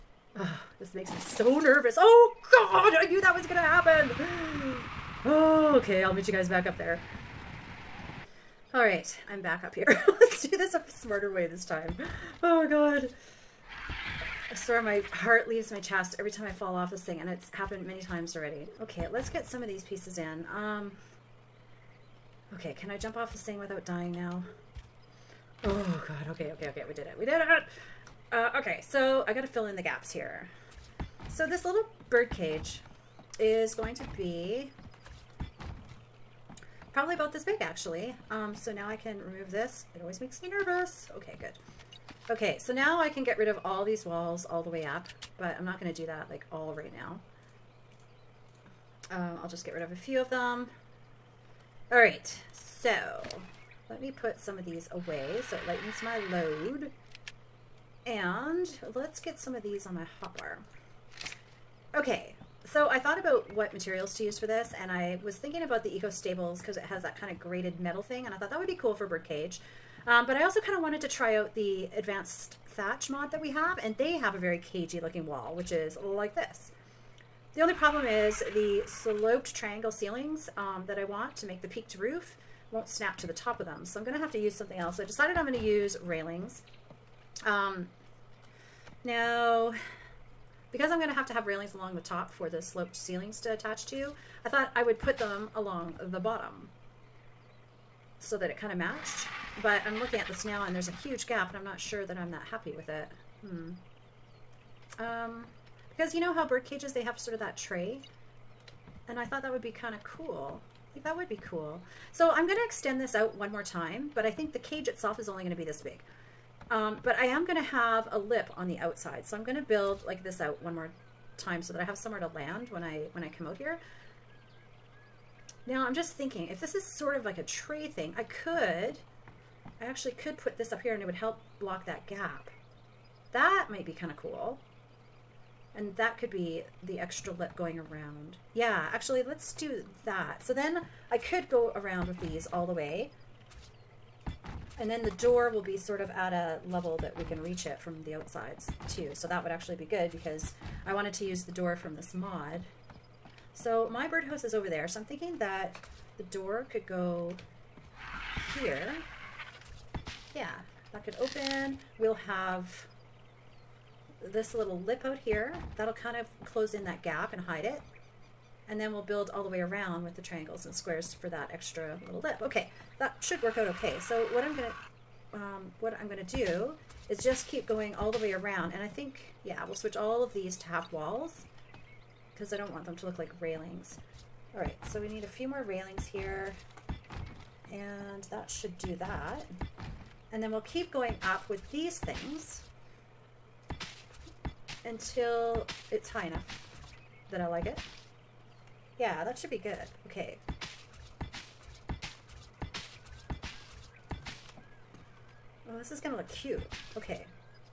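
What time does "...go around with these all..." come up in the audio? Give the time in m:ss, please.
2:21.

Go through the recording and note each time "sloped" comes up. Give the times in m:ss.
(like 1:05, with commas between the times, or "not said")
1:18, 1:32.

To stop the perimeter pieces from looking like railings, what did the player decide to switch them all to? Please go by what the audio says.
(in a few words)
half walls.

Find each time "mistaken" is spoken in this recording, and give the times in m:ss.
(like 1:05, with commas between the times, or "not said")
not said.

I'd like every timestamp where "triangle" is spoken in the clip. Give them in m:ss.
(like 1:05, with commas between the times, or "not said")
1:19, 2:50.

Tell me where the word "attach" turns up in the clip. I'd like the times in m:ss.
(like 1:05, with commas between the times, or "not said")
1:33.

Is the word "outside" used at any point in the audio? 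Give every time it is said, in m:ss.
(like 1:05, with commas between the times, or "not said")
1:58, 2:28.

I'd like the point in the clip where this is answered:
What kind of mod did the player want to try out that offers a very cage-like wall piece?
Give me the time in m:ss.
1:11.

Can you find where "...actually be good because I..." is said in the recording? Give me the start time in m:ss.
2:29.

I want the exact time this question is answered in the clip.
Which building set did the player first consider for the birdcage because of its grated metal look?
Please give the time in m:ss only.
1:05.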